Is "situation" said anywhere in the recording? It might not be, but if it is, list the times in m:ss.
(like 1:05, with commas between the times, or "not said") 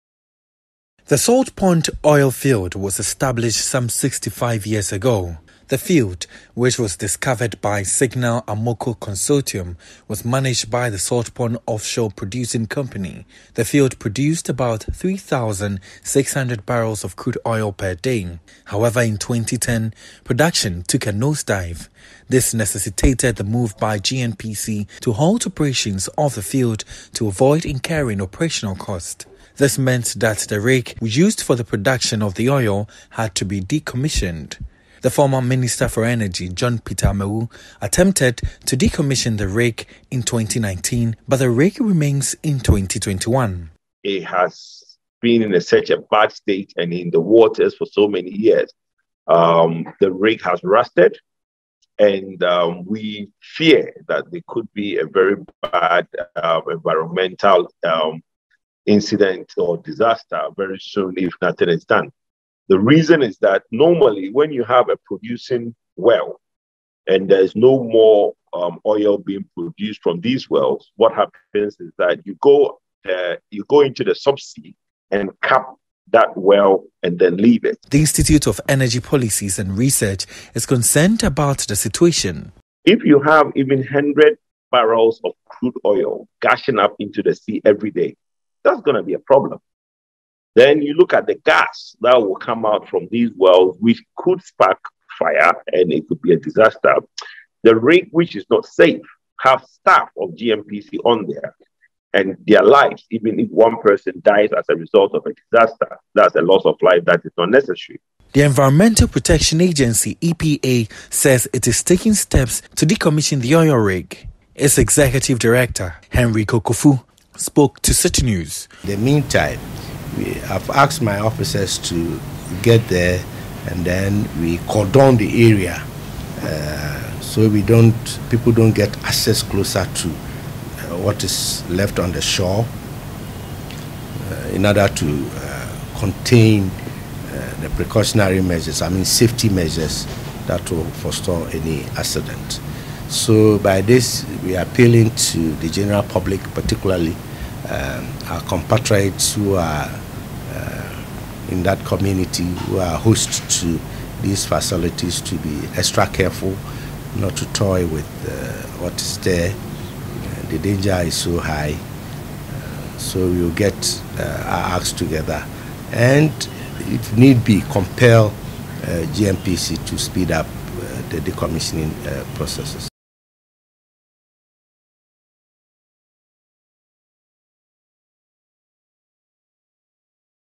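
1:21.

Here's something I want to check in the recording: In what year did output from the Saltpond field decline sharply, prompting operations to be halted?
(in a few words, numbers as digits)
2010.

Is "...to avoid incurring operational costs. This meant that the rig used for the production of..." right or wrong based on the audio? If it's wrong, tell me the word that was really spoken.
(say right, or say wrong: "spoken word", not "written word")
right.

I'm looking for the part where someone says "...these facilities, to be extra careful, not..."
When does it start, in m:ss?
2:34.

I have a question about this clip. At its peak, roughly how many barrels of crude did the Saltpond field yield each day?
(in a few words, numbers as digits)
3,600.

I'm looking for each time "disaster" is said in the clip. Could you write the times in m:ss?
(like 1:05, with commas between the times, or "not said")
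0:59, 1:36, 1:45.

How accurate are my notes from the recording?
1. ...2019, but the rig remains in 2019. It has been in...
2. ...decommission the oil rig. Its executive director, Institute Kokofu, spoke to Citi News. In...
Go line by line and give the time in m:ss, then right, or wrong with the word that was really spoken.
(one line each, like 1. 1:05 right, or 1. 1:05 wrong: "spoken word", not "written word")
1. 0:40 wrong: "2021", not "2019"
2. 1:52 wrong: "Henry", not "Institute".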